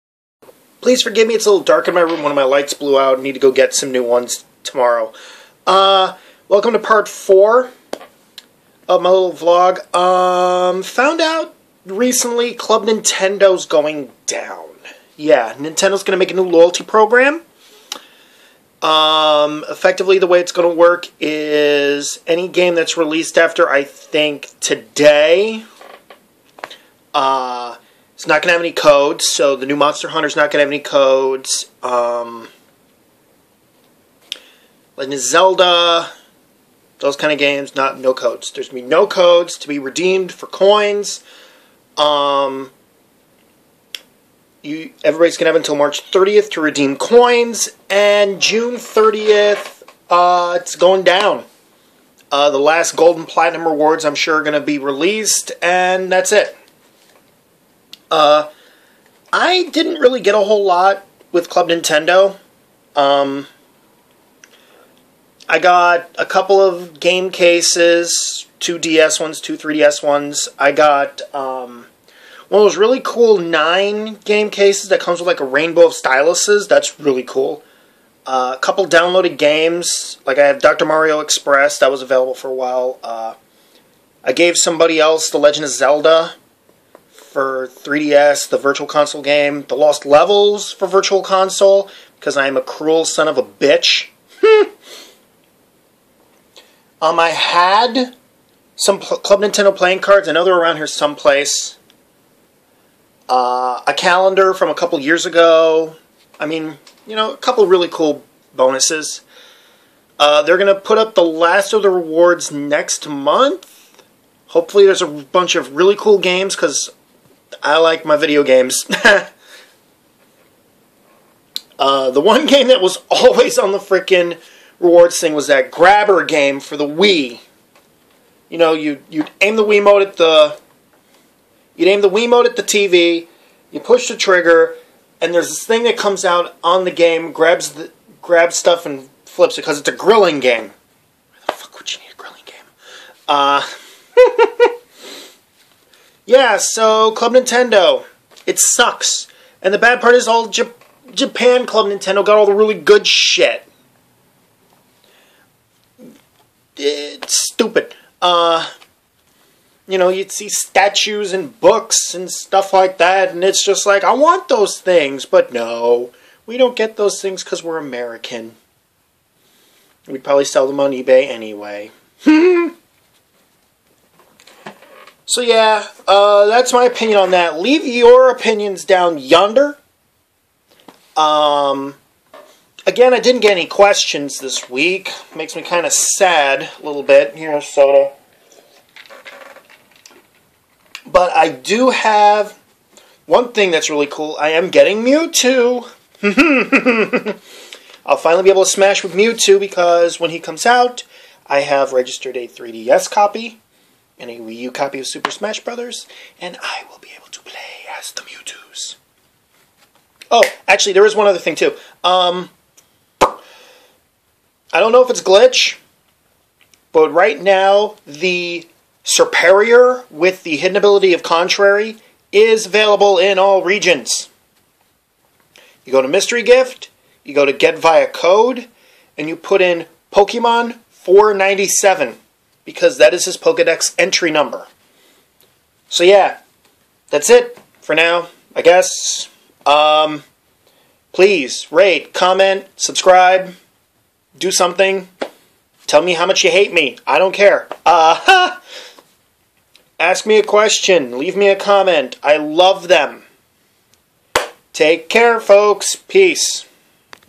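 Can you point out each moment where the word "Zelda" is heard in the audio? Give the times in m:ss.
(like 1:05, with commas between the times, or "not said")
0:35, 1:25.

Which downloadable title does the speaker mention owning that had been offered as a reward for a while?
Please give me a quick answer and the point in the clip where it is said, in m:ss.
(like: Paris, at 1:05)
Dr. Mario Express, at 1:20.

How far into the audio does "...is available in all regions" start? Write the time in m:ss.
3:42.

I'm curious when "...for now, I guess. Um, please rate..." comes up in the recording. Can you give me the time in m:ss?
3:57.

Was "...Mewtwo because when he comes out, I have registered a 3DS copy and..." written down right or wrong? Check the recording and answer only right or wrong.
right.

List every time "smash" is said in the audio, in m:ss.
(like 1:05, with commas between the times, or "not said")
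3:18, 3:25.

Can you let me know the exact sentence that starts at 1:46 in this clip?
I mean, you know, a couple really cool bonuses.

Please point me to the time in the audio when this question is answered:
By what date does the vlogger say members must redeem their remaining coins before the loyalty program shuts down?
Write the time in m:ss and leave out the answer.
0:45.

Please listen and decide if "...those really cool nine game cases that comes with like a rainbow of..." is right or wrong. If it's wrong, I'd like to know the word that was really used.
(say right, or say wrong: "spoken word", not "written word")
right.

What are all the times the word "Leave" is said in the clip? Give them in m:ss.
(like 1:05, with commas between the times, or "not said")
2:57, 4:11.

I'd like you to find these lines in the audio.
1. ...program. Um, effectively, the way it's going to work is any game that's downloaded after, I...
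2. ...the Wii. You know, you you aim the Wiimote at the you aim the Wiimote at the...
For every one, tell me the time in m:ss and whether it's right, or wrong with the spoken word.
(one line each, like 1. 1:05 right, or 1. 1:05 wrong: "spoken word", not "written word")
1. 0:16 wrong: "released", not "downloaded"
2. 2:06 right.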